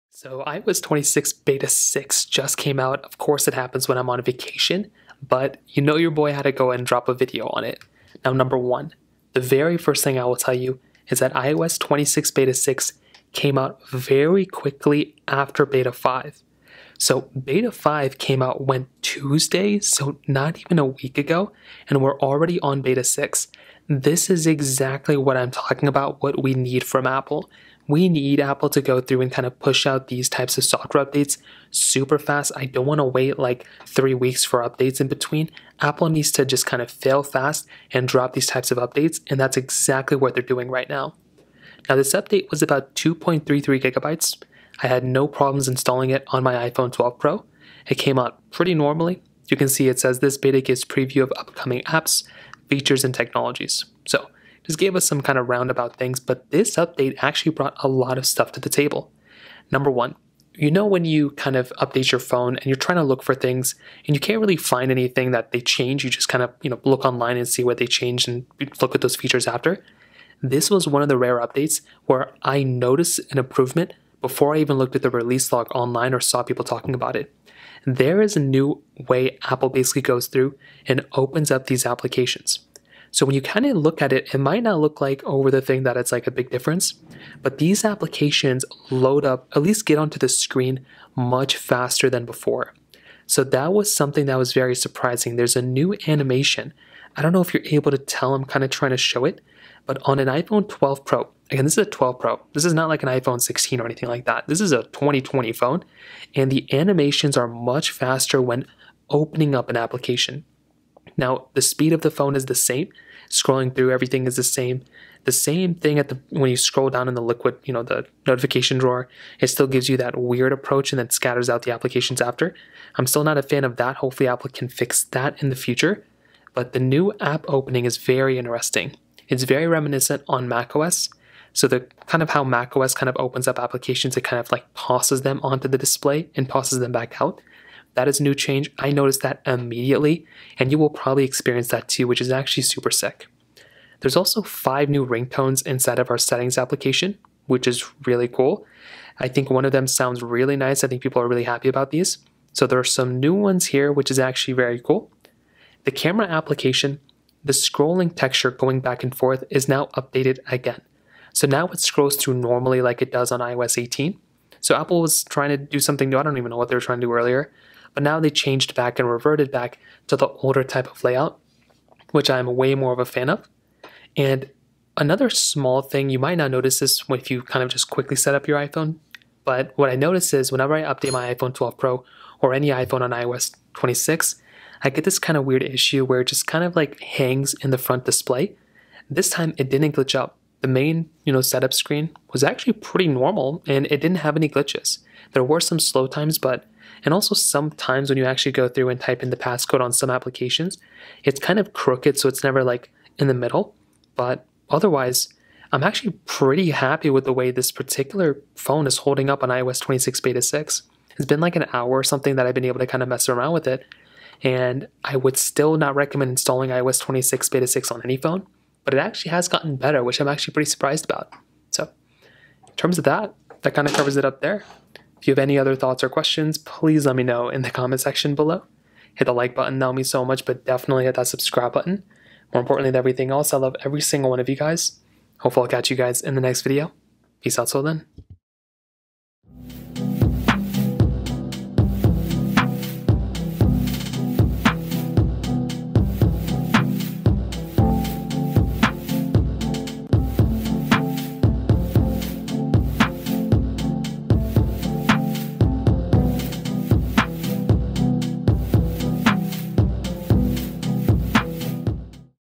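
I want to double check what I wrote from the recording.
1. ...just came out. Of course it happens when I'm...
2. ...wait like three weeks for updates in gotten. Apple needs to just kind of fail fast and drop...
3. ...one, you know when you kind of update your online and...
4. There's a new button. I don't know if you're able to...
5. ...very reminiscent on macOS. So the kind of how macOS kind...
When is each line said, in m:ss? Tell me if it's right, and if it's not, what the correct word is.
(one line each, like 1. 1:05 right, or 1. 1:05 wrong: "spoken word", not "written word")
1. 0:02 right
2. 0:33 wrong: "between", not "gotten"
3. 0:59 wrong: "phone", not "online"
4. 1:35 wrong: "animation", not "button"
5. 2:09 right.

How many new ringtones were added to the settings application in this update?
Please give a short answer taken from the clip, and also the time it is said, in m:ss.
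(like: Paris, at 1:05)
5, at 2:24.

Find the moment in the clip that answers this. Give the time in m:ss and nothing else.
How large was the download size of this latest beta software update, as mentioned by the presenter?
0:42.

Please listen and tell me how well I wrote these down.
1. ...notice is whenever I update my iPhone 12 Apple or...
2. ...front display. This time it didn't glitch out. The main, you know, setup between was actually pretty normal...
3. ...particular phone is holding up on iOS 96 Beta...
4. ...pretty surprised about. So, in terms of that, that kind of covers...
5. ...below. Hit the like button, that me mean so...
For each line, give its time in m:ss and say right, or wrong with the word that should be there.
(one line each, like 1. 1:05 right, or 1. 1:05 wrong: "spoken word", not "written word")
1. 2:59 wrong: "Pro", not "Apple"
2. 3:07 wrong: "screen", not "between"
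3. 3:27 wrong: "26", not "96"
4. 3:40 right
5. 3:48 right.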